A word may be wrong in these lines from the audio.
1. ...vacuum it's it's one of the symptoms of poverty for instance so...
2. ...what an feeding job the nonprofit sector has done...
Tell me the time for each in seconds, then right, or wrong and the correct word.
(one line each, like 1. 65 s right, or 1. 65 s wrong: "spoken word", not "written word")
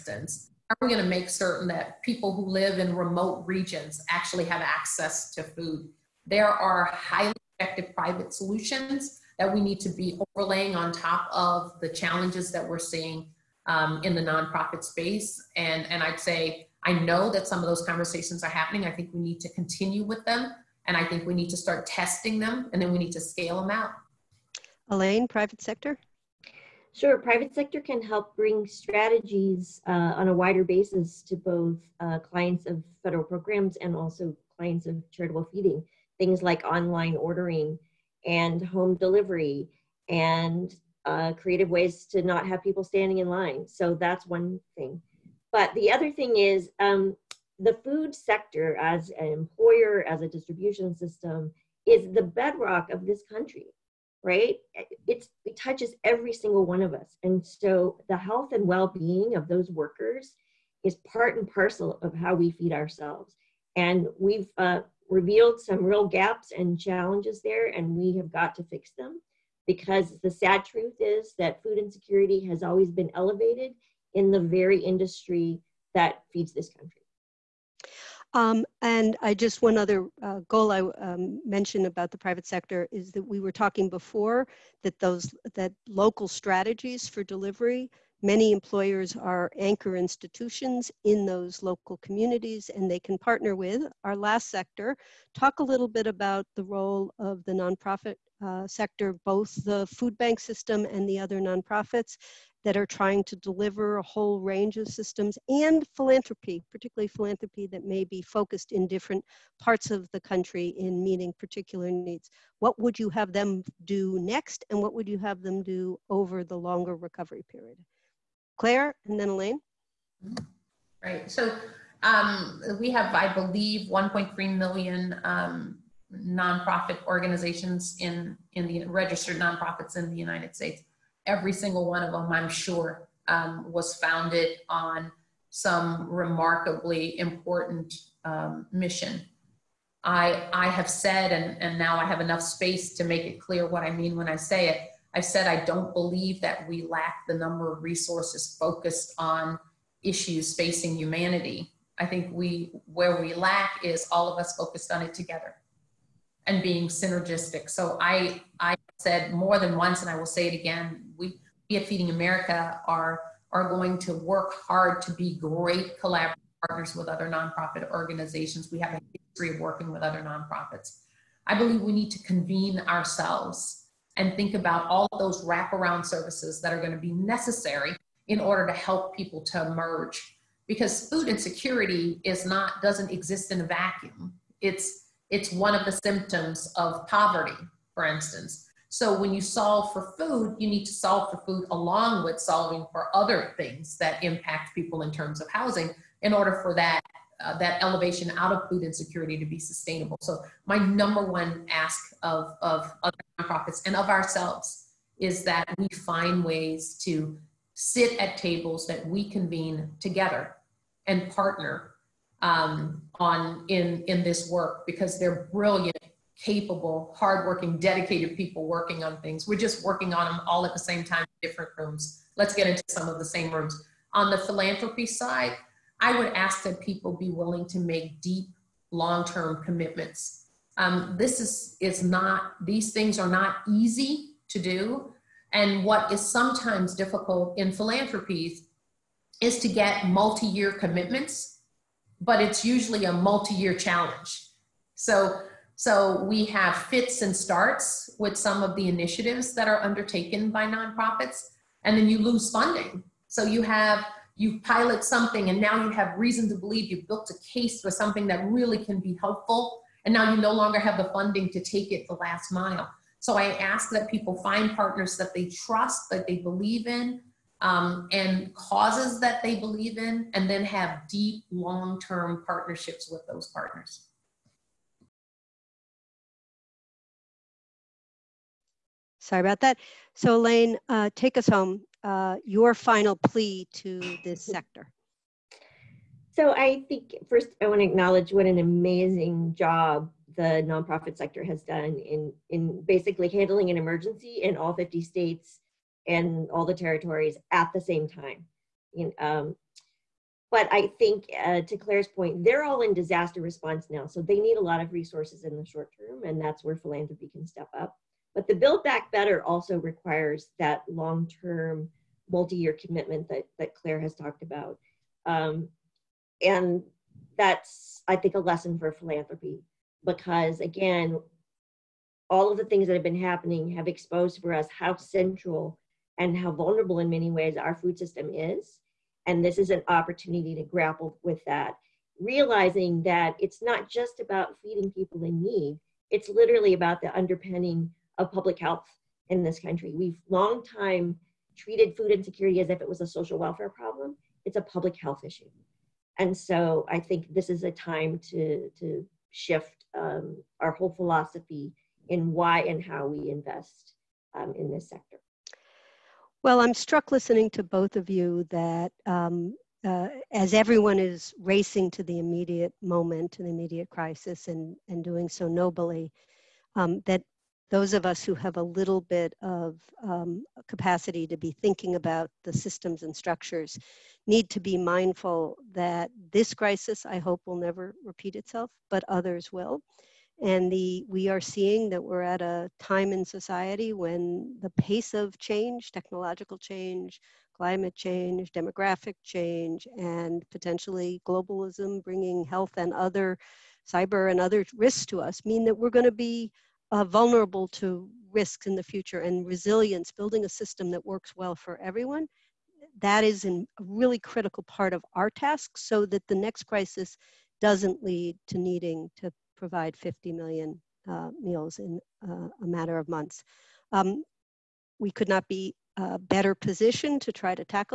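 1. 183 s right
2. 288 s wrong: "amazing", not "feeding".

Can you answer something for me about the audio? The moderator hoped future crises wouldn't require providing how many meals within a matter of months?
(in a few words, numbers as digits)
50 million.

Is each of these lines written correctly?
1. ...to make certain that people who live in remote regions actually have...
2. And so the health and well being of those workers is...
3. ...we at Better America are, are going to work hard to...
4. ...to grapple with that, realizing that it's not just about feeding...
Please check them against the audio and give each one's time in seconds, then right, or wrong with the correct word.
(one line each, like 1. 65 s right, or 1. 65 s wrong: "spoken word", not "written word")
1. 1 s right
2. 57 s right
3. 161 s wrong: "Feeding", not "Better"
4. 330 s right.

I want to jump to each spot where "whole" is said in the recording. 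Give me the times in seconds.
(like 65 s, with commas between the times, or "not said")
104 s, 350 s.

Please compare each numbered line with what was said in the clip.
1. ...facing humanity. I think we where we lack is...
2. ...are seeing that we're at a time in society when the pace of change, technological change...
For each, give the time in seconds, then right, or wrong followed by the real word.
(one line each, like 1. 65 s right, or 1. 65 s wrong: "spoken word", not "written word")
1. 150 s right
2. 381 s right.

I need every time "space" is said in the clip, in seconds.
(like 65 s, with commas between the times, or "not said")
14 s, 142 s.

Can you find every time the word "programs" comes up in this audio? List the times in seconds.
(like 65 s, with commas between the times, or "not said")
33 s.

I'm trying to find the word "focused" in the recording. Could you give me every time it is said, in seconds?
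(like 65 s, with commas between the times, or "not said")
108 s, 148 s, 154 s.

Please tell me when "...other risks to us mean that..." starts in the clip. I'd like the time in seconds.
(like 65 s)
394 s.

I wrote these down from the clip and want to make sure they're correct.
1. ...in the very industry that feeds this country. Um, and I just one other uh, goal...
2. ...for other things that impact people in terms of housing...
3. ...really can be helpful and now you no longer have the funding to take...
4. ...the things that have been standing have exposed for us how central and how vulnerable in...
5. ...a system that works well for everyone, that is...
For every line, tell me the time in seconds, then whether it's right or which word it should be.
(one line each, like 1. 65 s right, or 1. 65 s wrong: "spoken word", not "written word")
1. 74 s right
2. 192 s right
3. 258 s right
4. 322 s wrong: "happening", not "standing"
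5. 400 s right.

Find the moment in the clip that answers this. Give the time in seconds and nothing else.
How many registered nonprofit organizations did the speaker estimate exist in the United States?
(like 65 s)
123 s.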